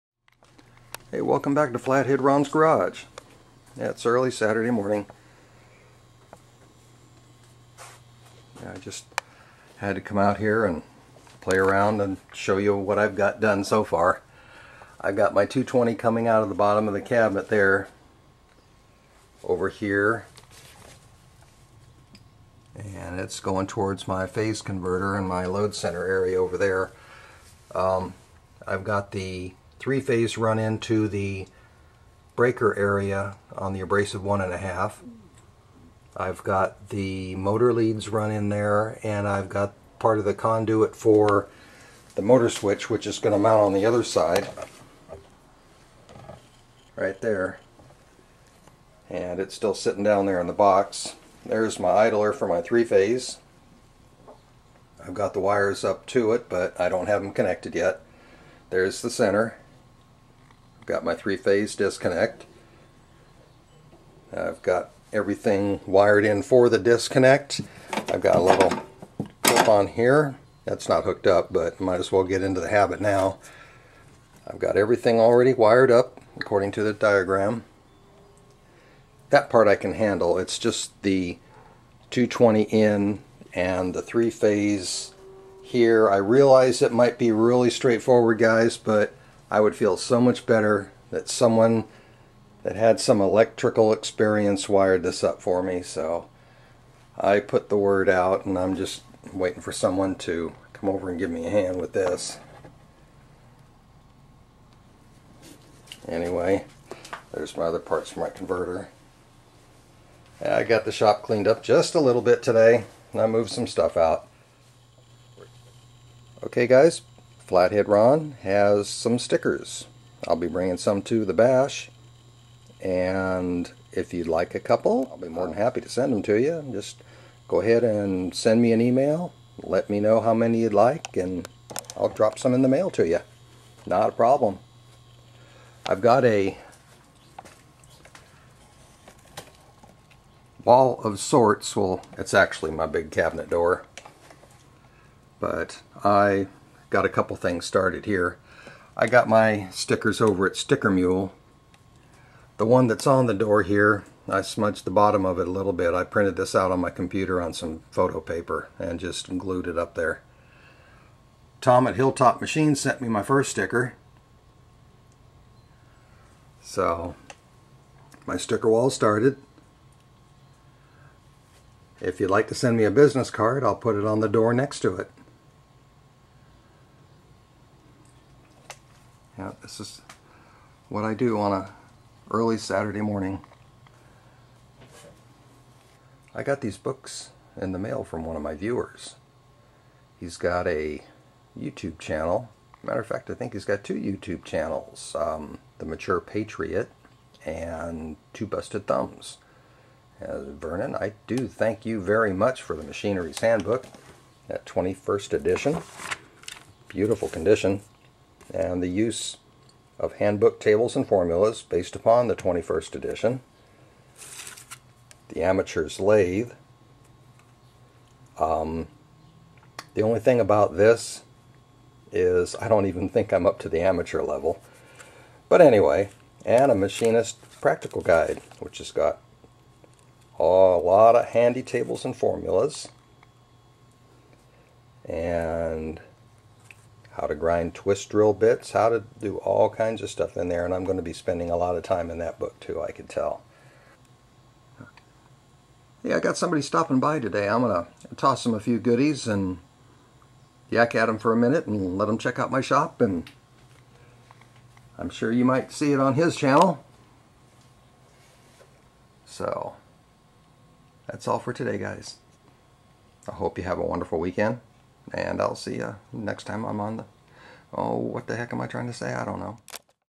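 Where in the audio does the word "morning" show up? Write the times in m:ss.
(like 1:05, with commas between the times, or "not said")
0:04, 3:03.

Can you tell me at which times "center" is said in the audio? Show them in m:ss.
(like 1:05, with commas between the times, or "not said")
0:25, 0:59.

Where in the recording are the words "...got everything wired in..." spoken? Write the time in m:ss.
1:04.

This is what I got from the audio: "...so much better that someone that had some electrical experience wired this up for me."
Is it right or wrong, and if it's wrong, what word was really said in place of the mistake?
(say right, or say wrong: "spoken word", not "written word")
right.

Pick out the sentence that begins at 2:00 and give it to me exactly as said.
I'll be bringing some to the bash.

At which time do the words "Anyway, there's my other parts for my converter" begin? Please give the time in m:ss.
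1:46.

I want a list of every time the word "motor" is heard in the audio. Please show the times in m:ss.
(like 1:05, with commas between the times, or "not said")
0:37, 0:42.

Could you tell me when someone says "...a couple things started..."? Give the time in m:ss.
2:27.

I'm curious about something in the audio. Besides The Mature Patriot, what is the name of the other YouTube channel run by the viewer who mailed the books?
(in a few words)
Two Busted Thumbs.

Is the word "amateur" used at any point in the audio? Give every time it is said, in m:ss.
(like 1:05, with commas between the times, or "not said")
3:35, 3:43.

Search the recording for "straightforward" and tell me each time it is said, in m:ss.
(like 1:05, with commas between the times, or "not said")
1:27.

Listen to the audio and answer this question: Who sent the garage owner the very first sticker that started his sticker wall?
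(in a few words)
Tom at Hilltop Machine.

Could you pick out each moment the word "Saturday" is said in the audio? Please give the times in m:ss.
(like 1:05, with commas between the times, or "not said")
0:04, 3:02.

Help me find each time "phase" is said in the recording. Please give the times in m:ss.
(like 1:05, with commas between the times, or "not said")
0:24, 0:29, 0:52, 1:01, 1:24.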